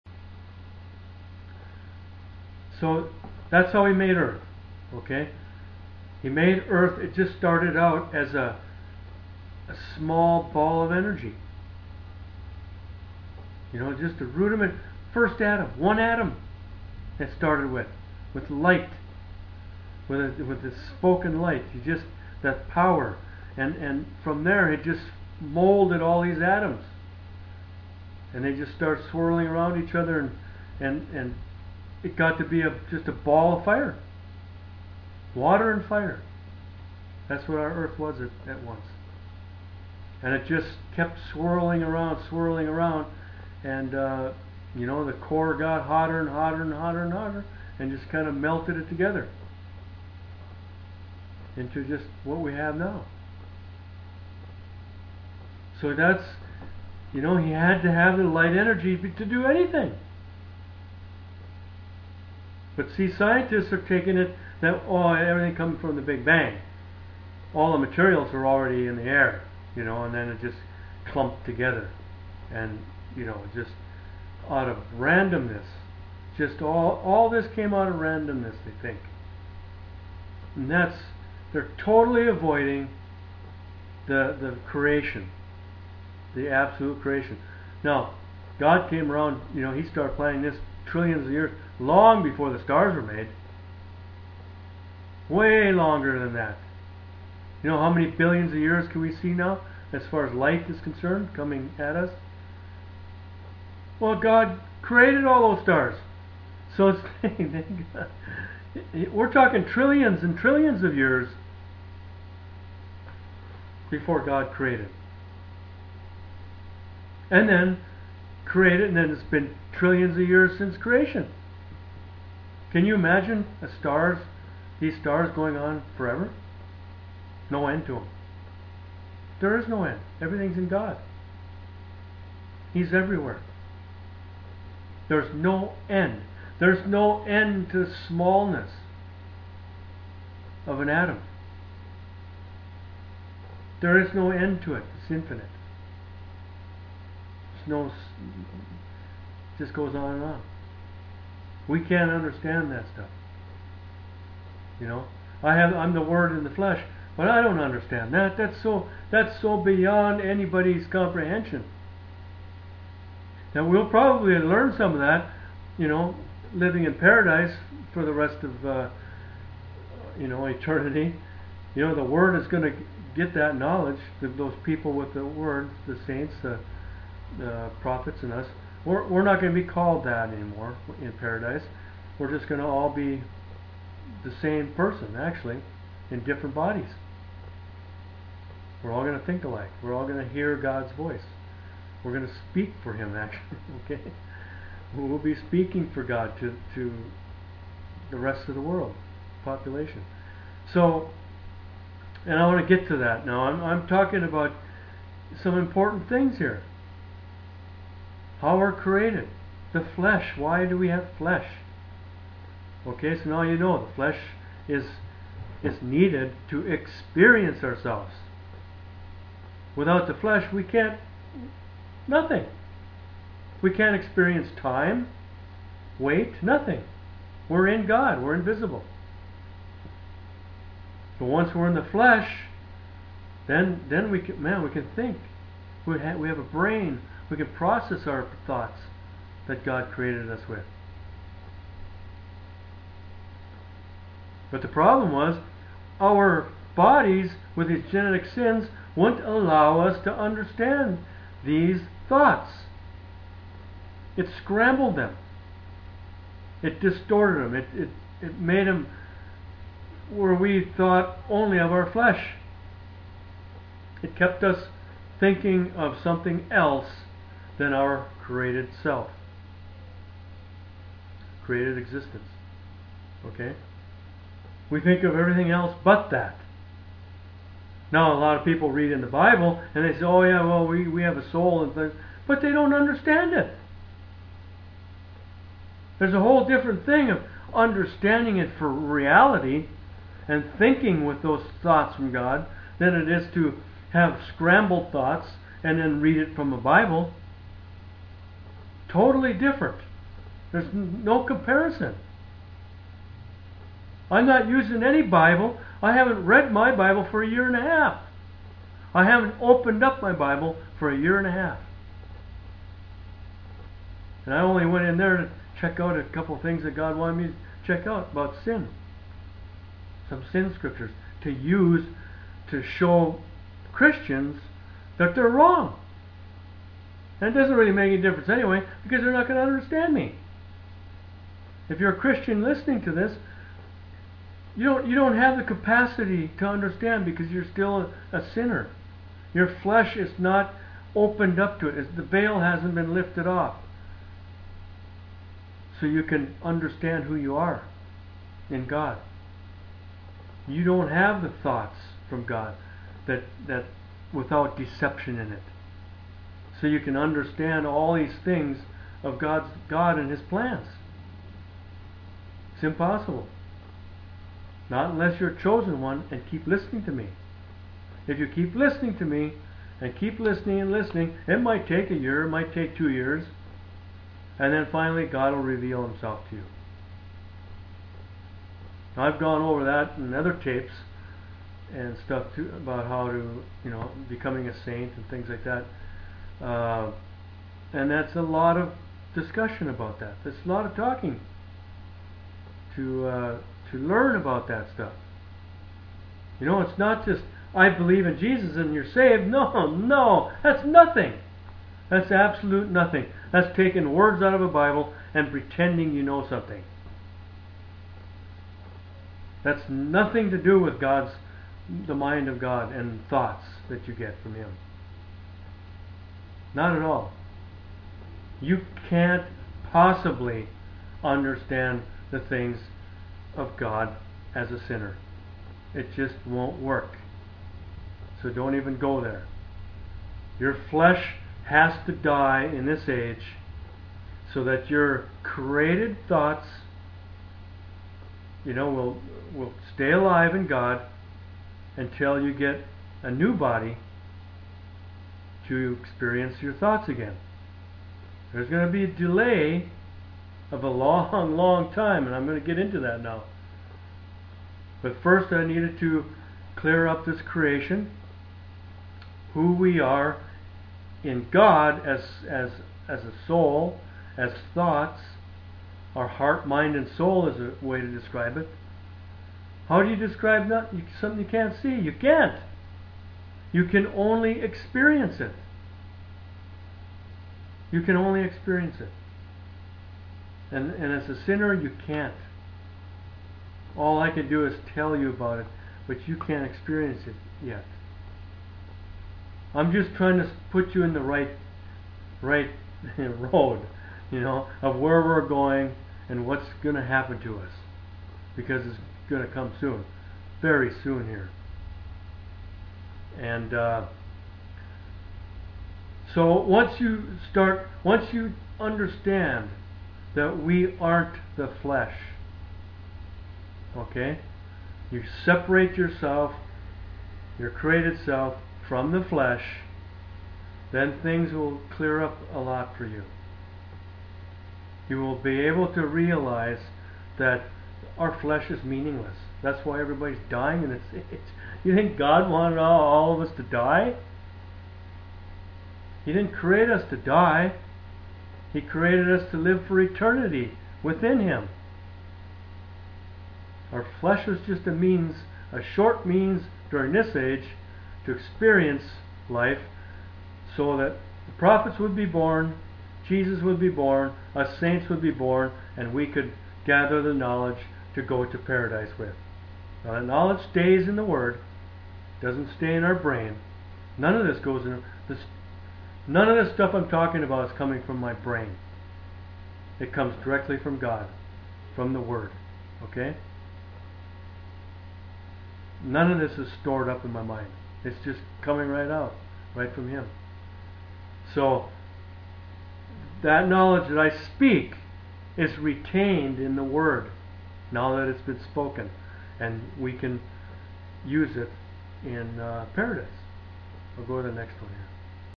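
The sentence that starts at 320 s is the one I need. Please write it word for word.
Some sin scriptures to use to show Christians that they're wrong.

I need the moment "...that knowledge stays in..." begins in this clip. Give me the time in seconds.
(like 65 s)
559 s.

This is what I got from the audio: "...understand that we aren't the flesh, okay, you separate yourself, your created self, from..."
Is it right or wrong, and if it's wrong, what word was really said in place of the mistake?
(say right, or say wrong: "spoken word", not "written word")
right.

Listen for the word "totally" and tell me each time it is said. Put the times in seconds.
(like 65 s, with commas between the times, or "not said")
81 s, 298 s.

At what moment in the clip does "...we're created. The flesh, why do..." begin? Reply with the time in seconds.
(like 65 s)
208 s.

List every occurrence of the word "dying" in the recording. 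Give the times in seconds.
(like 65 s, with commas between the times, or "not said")
530 s.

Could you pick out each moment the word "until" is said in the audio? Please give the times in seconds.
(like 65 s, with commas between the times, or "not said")
441 s.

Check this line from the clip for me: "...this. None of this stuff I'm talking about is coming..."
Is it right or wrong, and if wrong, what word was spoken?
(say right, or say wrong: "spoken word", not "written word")
right.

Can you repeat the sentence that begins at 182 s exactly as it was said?
We're just going to all be the same person, actually, in different bodies.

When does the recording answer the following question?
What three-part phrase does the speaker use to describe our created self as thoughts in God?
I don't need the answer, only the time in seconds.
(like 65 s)
466 s.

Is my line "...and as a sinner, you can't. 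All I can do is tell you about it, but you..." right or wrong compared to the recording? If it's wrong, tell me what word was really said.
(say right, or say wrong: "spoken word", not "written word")
right.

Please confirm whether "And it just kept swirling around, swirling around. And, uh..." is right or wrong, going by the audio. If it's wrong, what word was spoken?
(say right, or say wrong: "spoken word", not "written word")
right.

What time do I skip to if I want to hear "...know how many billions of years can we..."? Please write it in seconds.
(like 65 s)
97 s.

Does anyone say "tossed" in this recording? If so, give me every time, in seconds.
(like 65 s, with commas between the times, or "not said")
not said.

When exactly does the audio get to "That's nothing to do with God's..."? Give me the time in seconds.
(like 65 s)
409 s.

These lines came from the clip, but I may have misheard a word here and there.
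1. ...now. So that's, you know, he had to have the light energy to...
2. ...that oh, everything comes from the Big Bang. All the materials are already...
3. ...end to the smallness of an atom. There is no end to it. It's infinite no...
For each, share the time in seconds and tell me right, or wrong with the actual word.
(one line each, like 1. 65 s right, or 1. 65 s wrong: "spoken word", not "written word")
1. 52 s right
2. 64 s right
3. 137 s right.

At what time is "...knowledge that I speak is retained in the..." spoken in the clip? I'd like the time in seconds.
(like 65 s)
583 s.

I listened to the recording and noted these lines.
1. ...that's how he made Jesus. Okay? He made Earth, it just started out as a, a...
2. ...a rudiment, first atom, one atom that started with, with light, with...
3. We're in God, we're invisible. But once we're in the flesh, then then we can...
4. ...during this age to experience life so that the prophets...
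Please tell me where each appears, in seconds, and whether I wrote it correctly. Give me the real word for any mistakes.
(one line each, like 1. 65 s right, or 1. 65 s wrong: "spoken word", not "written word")
1. 3 s wrong: "Earth", not "Jesus"
2. 14 s right
3. 227 s right
4. 546 s right.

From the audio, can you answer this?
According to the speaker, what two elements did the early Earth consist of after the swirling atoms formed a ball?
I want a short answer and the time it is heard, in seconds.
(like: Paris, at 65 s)
Water and fire, at 35 s.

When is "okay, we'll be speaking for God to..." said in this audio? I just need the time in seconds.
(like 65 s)
193 s.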